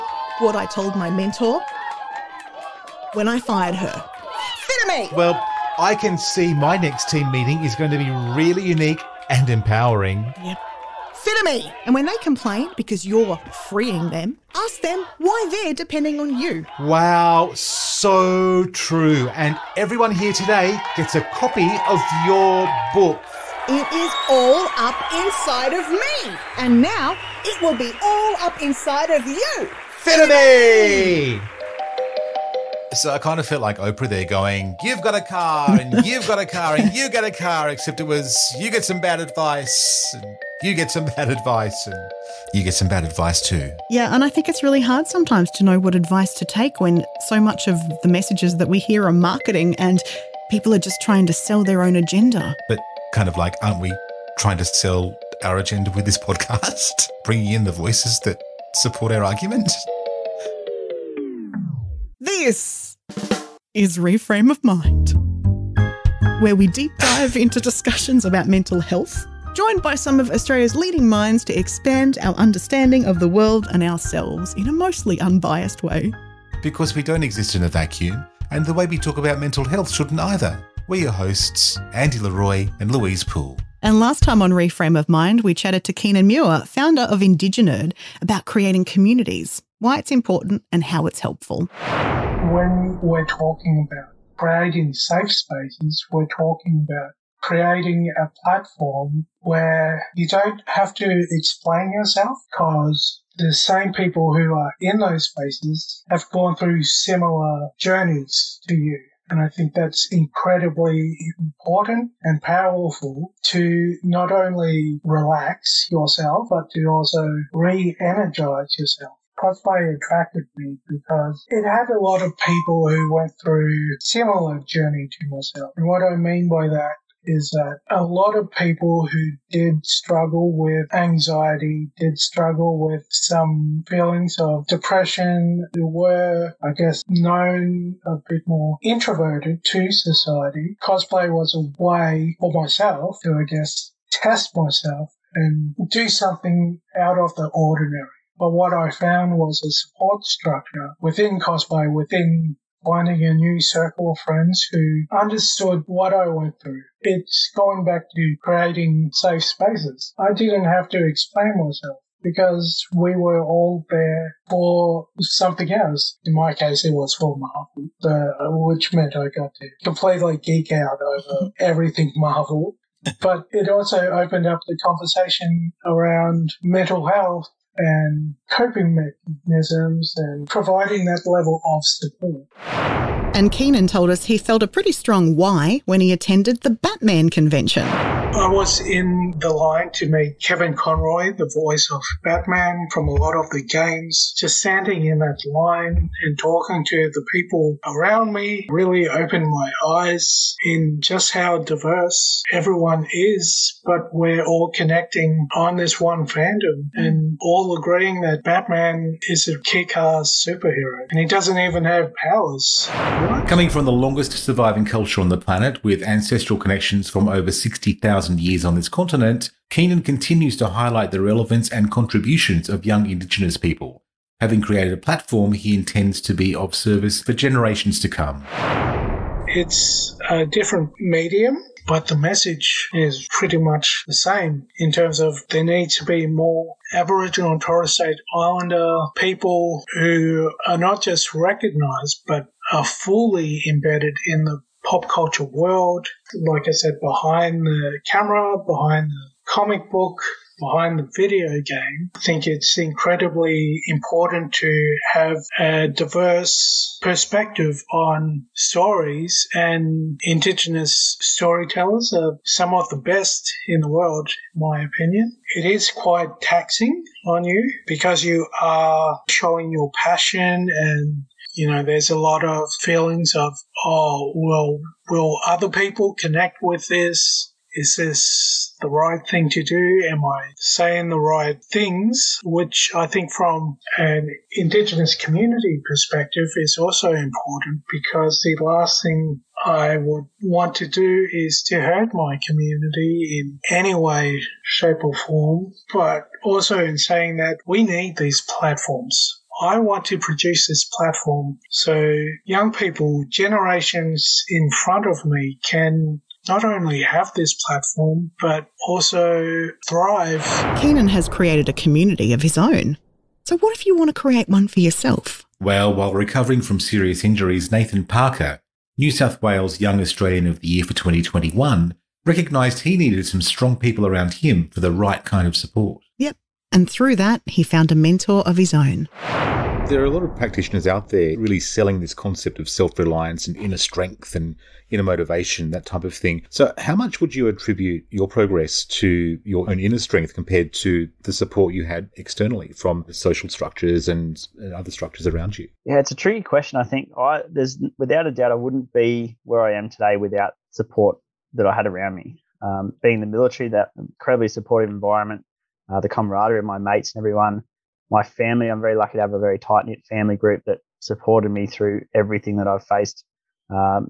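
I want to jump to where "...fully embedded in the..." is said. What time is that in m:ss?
4:02.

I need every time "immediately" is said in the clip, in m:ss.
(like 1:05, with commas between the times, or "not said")
not said.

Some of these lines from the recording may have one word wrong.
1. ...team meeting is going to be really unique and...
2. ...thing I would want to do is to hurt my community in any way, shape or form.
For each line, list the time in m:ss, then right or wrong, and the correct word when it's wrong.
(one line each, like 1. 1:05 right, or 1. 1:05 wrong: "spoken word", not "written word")
1. 0:07 right
2. 4:49 right.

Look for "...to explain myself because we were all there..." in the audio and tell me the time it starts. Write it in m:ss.
2:40.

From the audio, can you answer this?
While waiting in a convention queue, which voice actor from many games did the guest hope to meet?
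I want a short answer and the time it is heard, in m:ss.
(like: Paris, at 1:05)
Kevin Conroy, at 3:10.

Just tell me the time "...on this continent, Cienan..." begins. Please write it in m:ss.
3:38.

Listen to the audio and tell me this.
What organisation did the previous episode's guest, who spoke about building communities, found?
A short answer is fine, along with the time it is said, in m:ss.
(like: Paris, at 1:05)
Indiginerd, at 1:27.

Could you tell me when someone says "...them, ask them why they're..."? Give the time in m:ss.
0:14.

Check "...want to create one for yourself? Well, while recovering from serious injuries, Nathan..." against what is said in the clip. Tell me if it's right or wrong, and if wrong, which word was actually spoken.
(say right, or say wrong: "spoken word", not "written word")
right.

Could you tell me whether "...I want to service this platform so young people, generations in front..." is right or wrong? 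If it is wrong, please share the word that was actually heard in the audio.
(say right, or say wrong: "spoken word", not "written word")
wrong: "produce", not "service".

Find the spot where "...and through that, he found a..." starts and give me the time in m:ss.
5:26.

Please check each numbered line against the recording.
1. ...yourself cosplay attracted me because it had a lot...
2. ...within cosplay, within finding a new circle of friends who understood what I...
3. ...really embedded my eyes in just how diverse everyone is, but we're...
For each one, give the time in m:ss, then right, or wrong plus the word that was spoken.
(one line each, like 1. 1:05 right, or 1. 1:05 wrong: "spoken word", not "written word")
1. 1:58 right
2. 2:30 right
3. 3:18 wrong: "opened", not "embedded".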